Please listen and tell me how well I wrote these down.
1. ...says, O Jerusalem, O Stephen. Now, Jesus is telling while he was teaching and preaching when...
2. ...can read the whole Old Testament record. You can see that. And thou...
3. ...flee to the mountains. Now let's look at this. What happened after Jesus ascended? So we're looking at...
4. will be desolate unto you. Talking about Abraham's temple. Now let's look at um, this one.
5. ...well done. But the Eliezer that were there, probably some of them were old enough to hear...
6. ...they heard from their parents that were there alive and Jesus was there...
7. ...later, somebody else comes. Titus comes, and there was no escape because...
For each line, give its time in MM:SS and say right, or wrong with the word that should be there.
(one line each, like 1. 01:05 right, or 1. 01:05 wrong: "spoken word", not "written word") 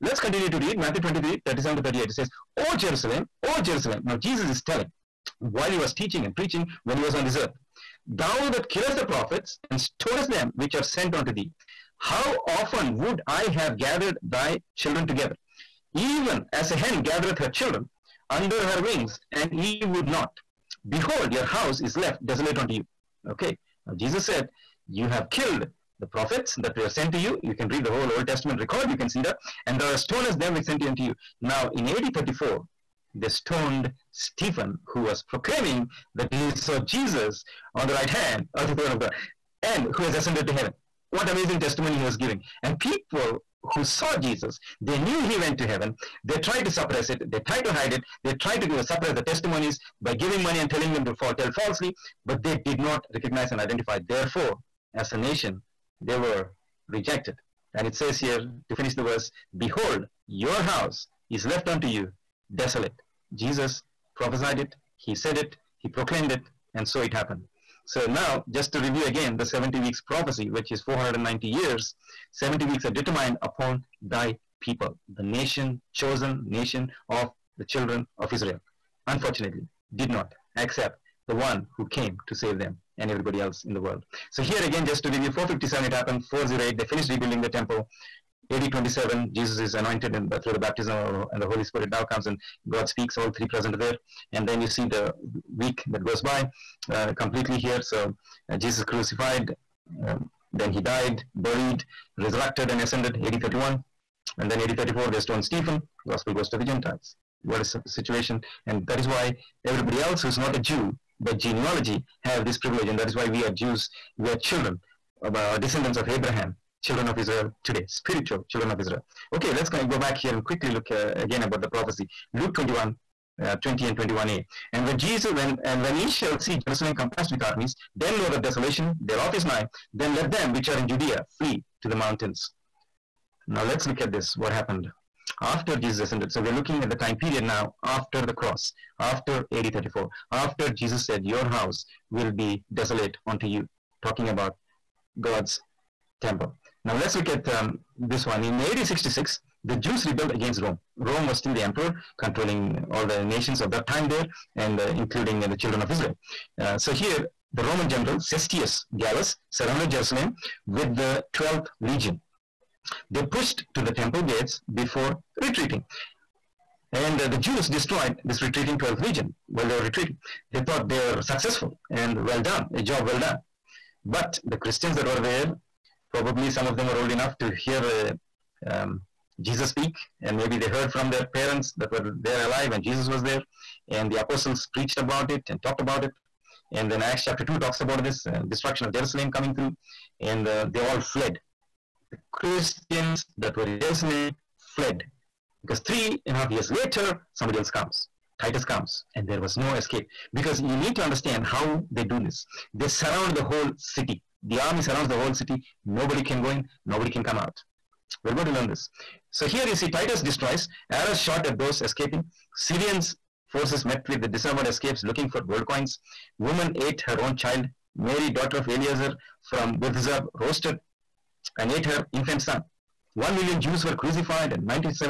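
1. 00:02 wrong: "Jerusalem", not "Stephen"
2. 00:27 right
3. 02:11 right
4. 02:22 wrong: "God", not "Abraham"
5. 02:53 wrong: "Christians", not "Eliezer"
6. 03:00 right
7. 03:16 right.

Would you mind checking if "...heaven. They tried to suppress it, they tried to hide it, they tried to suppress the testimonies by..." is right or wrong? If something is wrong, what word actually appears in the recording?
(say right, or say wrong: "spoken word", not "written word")
right.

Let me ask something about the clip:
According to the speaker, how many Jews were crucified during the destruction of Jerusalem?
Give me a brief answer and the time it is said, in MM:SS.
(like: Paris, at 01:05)
1 million, at 03:43.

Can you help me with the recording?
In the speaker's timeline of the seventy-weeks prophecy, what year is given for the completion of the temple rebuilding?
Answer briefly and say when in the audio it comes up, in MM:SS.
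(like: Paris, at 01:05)
408, at 01:26.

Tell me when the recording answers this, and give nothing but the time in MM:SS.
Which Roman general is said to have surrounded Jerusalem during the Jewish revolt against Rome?
02:38.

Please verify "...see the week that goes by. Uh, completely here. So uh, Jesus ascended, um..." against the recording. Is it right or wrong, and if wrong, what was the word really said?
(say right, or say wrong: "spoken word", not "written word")
wrong: "crucified", not "ascended".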